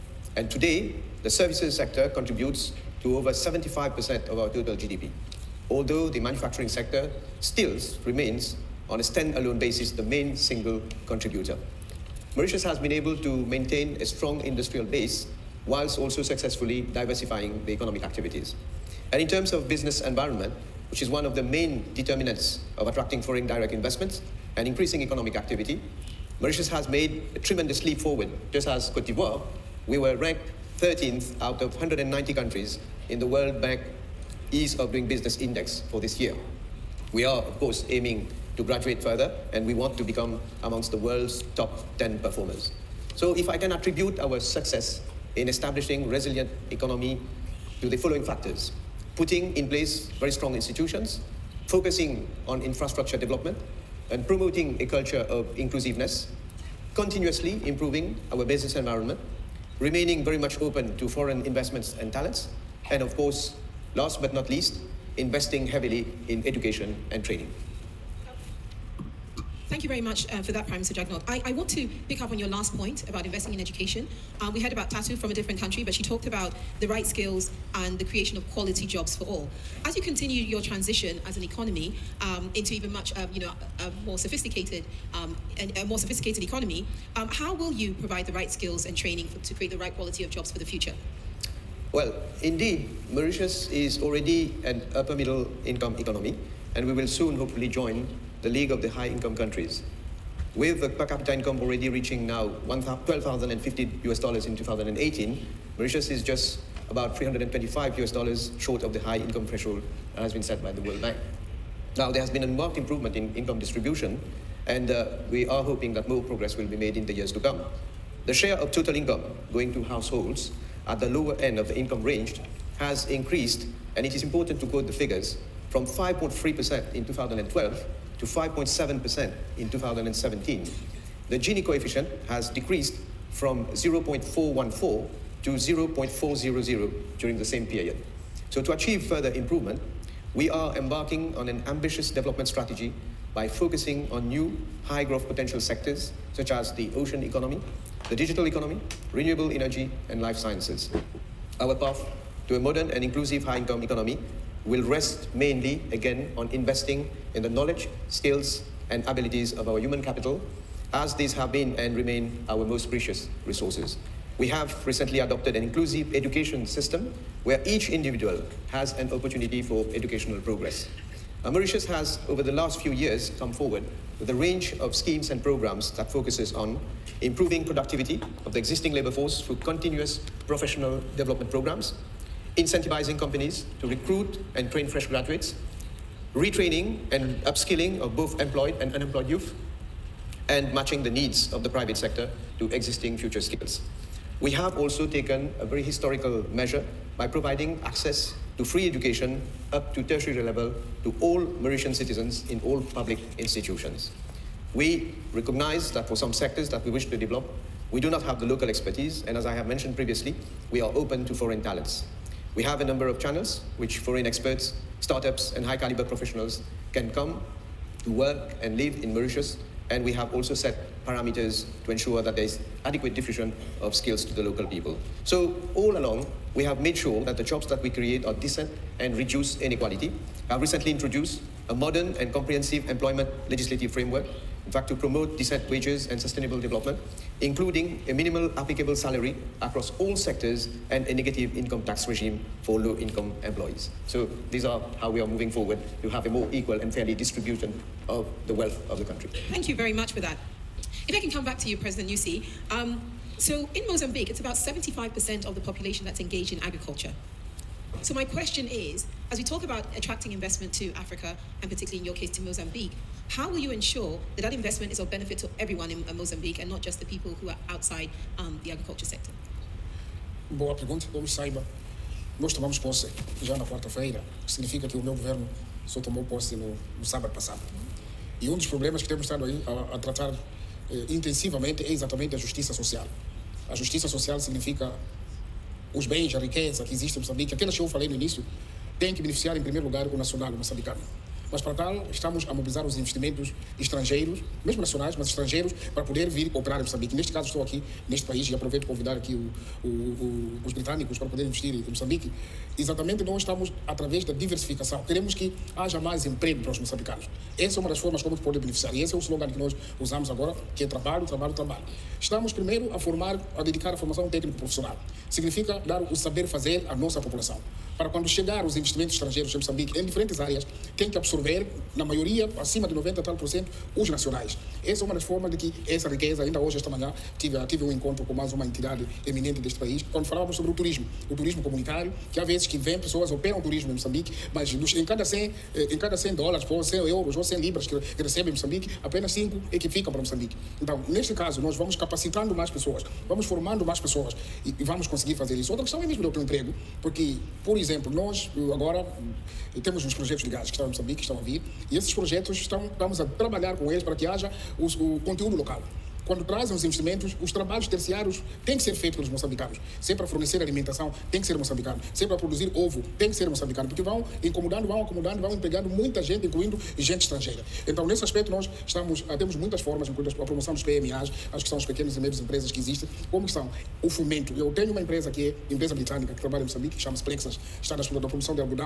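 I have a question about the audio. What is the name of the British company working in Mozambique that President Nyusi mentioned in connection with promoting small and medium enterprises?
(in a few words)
Plexas.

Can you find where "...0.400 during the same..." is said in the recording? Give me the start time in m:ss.
2:15.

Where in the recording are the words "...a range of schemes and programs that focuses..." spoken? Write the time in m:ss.
2:54.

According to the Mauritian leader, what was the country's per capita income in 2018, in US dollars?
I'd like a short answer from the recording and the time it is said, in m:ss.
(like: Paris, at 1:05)
12,050 US dollars, at 1:42.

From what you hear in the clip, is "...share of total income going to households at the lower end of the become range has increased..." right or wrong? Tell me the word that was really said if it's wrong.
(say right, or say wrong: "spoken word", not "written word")
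wrong: "income", not "become".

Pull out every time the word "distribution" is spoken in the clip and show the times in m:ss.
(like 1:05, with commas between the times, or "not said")
1:53, 4:07.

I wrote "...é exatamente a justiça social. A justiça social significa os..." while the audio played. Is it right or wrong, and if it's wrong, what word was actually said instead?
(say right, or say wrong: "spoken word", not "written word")
right.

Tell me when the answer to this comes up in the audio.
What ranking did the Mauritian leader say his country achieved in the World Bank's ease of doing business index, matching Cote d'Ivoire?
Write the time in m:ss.
0:30.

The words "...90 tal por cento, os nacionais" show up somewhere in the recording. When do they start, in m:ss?
5:22.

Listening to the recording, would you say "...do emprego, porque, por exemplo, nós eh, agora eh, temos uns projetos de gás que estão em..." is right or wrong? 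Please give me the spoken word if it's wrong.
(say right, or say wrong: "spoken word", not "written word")
right.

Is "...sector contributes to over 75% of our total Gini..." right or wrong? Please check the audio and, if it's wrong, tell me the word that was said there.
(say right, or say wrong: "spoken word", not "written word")
wrong: "GDP", not "Gini".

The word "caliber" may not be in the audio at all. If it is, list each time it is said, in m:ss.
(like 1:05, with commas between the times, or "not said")
3:35.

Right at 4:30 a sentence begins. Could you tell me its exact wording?
Boa pergunta, como saiba, nós tomamos posse já na quarta-feira.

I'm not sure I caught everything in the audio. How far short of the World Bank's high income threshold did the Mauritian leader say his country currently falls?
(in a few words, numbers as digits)
325 US dollars.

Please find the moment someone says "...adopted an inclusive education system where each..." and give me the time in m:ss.
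2:45.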